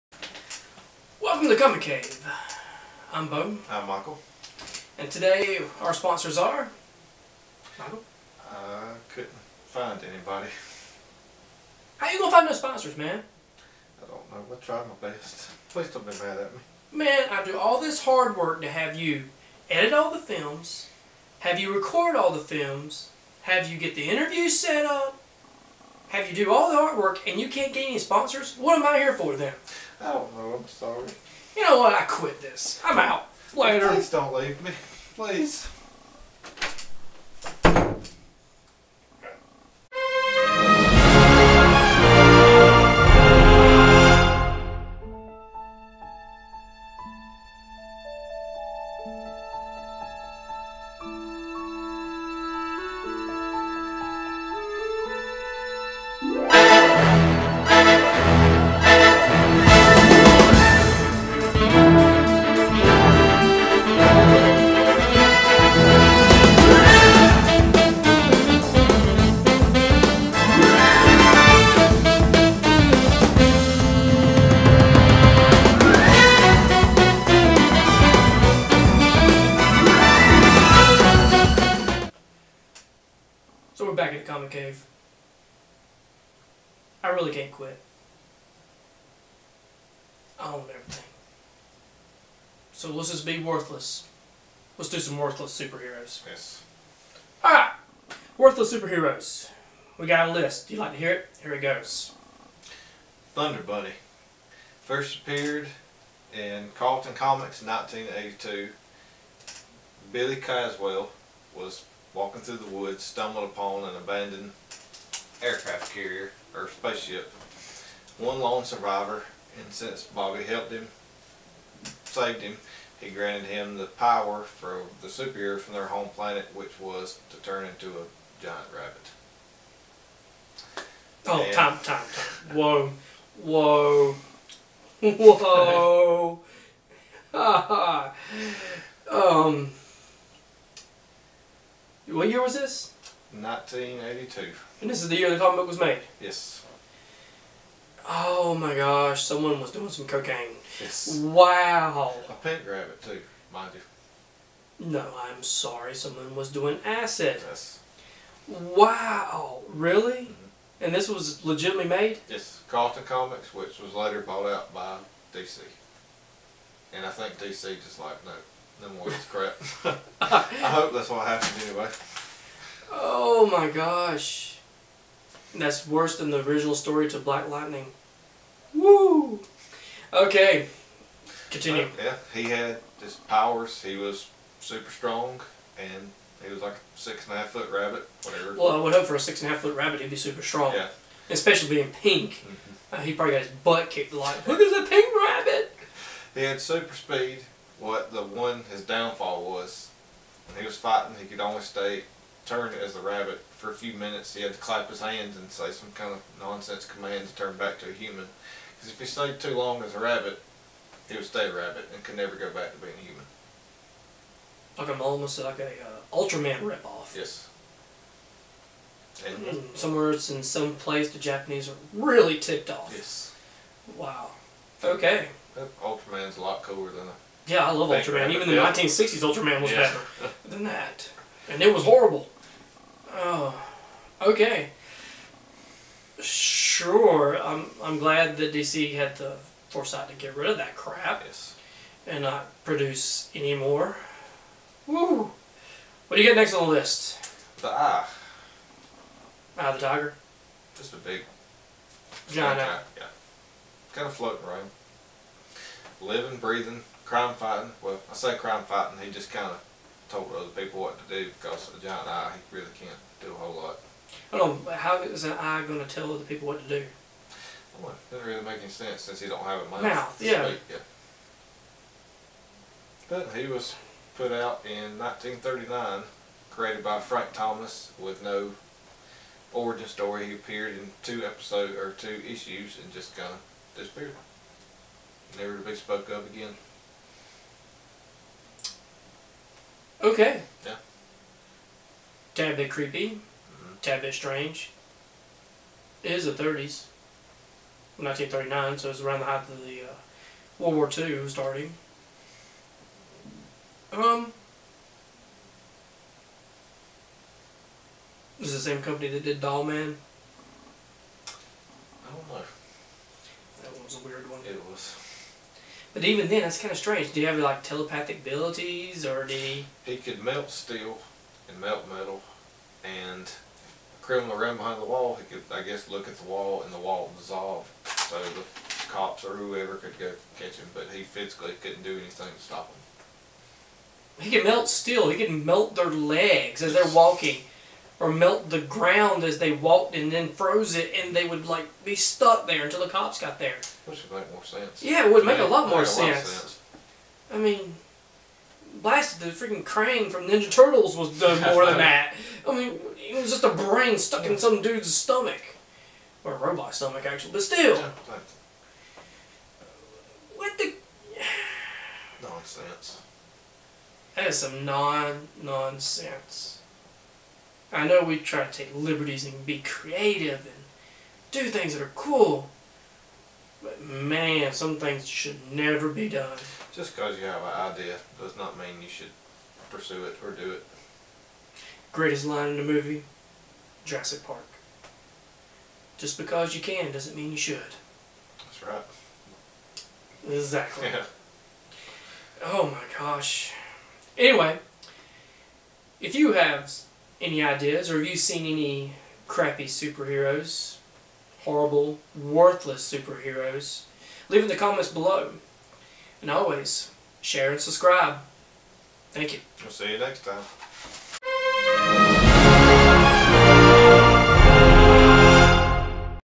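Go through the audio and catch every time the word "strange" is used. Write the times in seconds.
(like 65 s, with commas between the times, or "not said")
294 s, 316 s.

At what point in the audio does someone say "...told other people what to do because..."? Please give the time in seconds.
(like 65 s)
260 s.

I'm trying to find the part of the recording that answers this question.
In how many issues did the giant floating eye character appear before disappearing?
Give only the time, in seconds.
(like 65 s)
281 s.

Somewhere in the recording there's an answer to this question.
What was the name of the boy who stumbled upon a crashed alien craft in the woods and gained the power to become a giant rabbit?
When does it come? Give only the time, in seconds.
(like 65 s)
110 s.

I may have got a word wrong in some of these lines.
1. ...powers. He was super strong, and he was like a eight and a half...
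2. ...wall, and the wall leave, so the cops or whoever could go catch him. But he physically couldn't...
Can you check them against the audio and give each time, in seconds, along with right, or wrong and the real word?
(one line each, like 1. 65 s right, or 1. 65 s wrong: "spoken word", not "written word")
1. 183 s wrong: "six", not "eight"
2. 326 s wrong: "dissolve", not "leave".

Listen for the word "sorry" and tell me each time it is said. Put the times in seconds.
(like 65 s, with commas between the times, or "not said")
30 s, 155 s.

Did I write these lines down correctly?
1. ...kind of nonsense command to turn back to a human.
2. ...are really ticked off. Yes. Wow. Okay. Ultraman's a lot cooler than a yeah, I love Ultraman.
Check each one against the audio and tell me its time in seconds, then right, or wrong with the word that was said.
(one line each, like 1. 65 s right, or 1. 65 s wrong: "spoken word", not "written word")
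1. 205 s right
2. 221 s right.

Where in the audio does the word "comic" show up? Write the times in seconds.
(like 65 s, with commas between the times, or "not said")
1 s, 84 s, 107 s, 145 s, 163 s.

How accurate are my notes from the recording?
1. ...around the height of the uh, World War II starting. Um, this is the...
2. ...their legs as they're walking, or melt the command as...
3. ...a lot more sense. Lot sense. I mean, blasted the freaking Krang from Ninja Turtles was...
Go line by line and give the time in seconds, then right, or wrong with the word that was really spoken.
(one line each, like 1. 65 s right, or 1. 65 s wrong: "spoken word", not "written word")
1. 299 s right
2. 335 s wrong: "ground", not "command"
3. 345 s right.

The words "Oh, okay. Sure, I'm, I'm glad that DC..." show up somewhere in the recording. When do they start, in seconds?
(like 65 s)
233 s.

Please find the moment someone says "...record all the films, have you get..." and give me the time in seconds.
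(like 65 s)
21 s.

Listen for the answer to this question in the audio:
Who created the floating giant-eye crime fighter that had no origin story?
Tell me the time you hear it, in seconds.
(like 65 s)
277 s.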